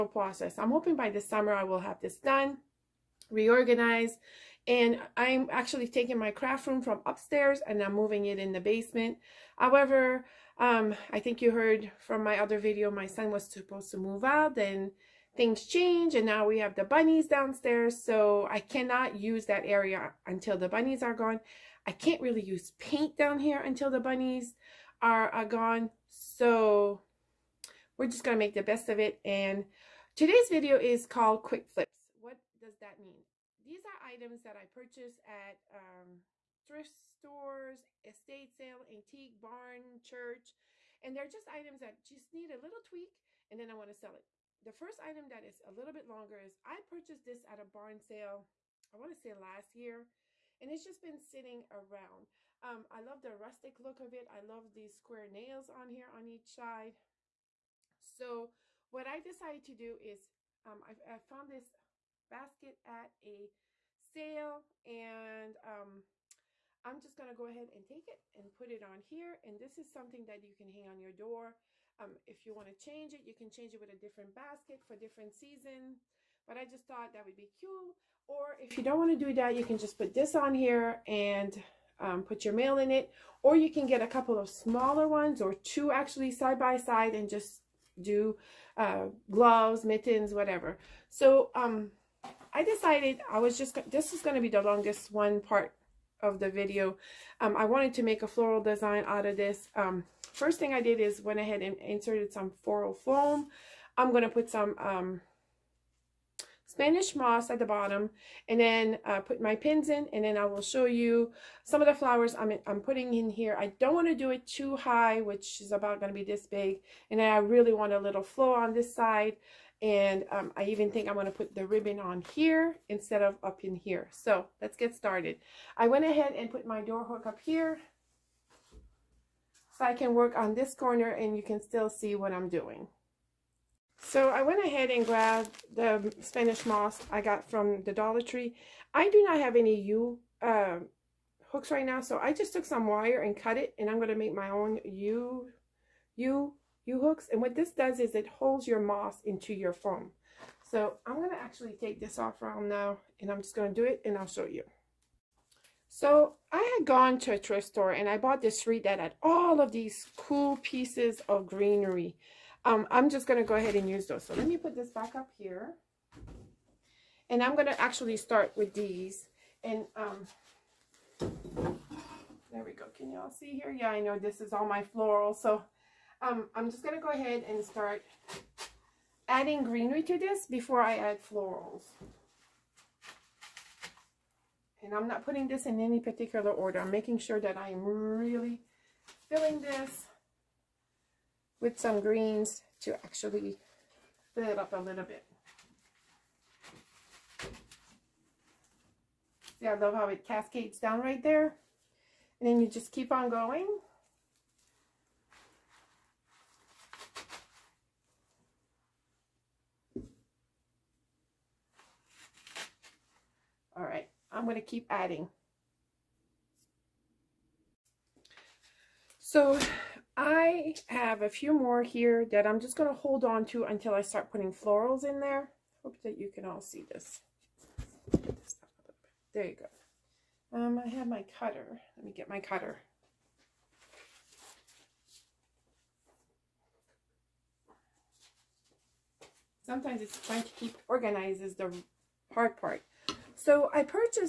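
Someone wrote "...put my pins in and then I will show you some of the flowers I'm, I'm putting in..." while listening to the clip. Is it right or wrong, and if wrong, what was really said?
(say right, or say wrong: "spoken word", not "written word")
right.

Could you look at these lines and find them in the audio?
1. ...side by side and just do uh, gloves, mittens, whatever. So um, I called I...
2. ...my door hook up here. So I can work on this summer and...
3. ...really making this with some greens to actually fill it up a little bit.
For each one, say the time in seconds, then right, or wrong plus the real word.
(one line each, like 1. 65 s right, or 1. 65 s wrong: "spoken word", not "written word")
1. 86 s wrong: "decided", not "called"
2. 126 s wrong: "corner", not "summer"
3. 187 s wrong: "filling", not "making".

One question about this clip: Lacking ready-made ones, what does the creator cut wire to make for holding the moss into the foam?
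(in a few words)
U-hooks.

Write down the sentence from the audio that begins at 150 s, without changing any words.
So I'm going to actually take this off round now and I'm just going to do it and I'll show you.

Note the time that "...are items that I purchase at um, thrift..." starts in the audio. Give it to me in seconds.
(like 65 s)
33 s.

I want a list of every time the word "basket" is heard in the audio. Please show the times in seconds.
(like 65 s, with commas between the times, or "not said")
62 s, 74 s.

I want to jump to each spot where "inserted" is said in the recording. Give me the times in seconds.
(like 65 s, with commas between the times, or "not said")
101 s.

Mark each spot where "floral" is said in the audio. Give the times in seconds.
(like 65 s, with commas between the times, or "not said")
98 s, 102 s, 174 s, 181 s, 224 s.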